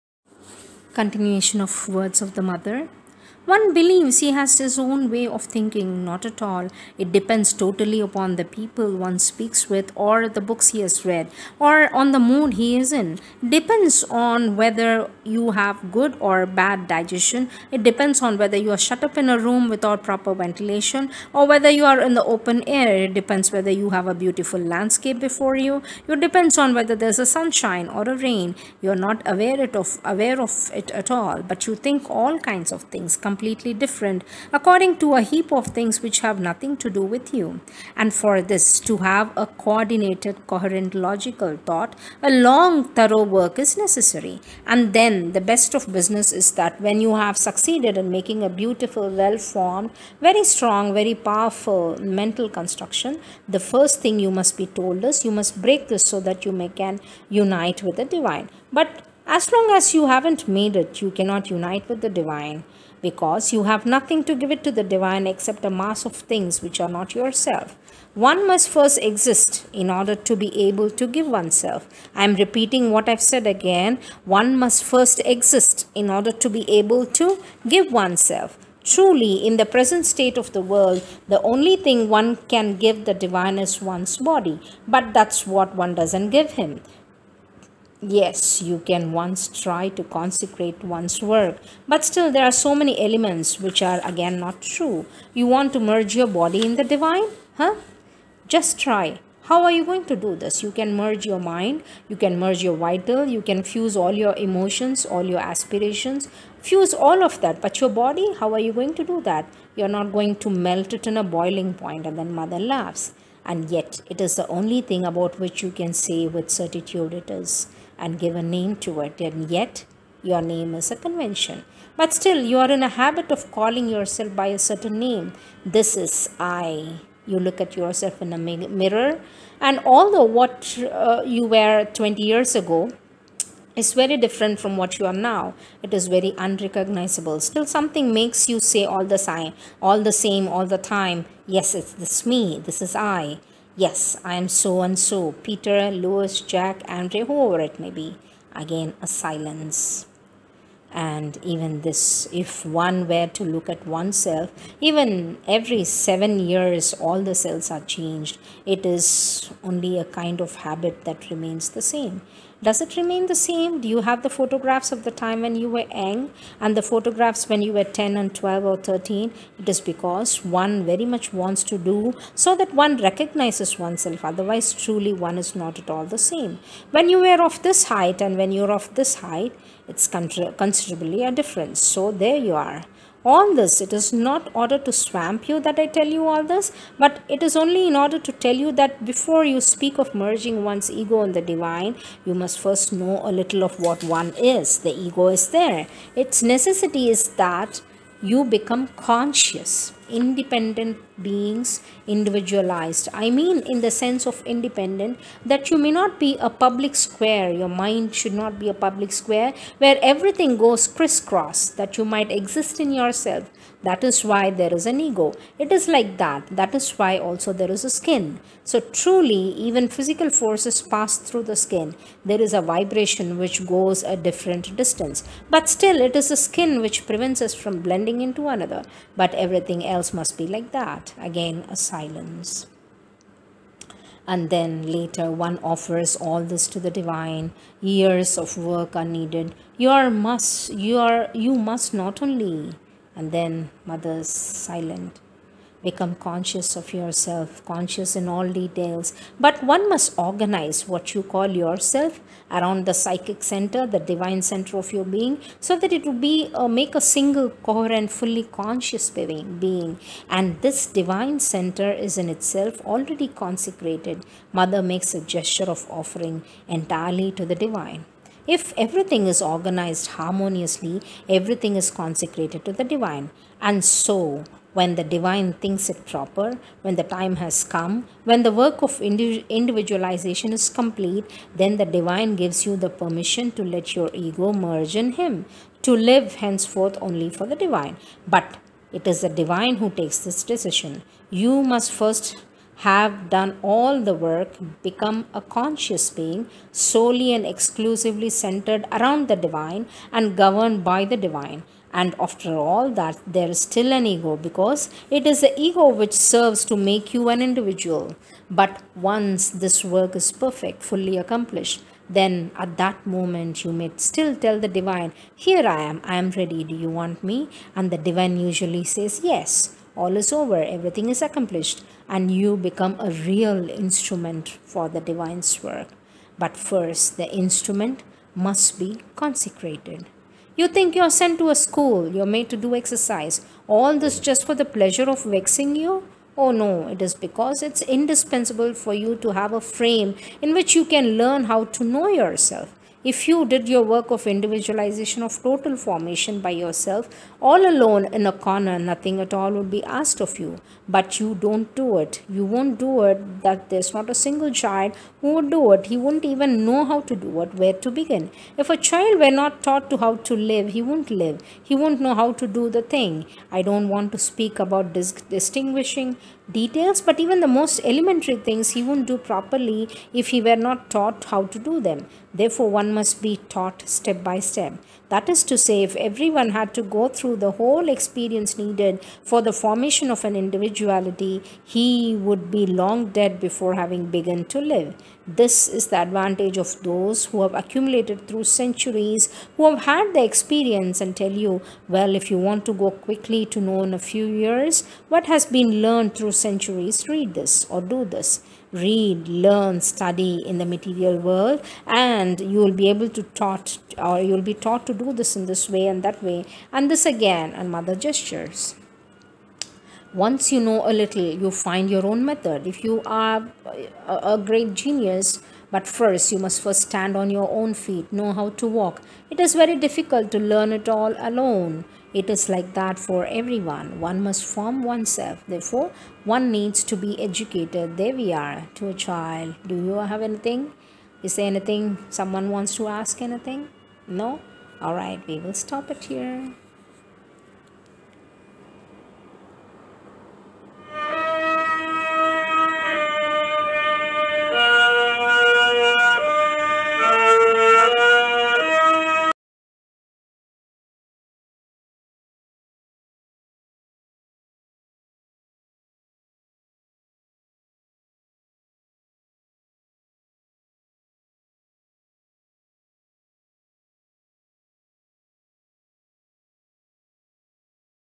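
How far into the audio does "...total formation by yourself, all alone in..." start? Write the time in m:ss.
5:45.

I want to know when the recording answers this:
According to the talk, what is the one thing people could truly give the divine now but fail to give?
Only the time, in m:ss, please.
1:23.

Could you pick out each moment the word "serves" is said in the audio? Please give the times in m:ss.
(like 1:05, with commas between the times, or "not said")
5:06.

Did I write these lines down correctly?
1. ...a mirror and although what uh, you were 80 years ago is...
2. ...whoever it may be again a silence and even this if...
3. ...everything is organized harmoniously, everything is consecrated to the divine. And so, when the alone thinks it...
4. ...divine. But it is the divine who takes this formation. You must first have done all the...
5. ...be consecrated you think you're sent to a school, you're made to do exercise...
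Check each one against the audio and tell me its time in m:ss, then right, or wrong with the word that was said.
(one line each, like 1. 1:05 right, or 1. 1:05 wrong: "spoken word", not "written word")
1. 2:08 wrong: "20", not "80"
2. 2:27 right
3. 4:28 wrong: "divine", not "alone"
4. 4:47 wrong: "decision", not "formation"
5. 5:28 right.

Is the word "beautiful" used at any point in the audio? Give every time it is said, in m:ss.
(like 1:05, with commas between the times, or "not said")
0:24, 0:48.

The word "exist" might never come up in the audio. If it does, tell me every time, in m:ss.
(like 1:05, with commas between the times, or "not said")
1:08, 1:15, 3:32.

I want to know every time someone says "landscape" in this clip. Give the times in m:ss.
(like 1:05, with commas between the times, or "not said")
0:24.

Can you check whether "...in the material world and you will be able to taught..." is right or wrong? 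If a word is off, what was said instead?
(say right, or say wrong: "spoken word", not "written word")
right.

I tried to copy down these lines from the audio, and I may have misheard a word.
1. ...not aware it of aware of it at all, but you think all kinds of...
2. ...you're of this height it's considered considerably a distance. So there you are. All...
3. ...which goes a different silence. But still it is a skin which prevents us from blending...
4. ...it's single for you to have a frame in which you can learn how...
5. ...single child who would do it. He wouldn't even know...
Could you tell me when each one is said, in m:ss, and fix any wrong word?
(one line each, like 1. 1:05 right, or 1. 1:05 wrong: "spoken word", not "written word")
1. 0:29 right
2. 2:58 wrong: "difference", not "distance"
3. 3:43 wrong: "distance", not "silence"
4. 5:37 wrong: "indispensable", not "single"
5. 5:54 right.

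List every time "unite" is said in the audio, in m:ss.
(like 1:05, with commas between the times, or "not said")
0:57, 1:01.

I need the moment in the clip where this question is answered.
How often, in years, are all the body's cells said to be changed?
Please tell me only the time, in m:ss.
2:35.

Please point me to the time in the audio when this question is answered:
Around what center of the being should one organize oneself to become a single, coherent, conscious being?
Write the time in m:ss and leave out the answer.
4:12.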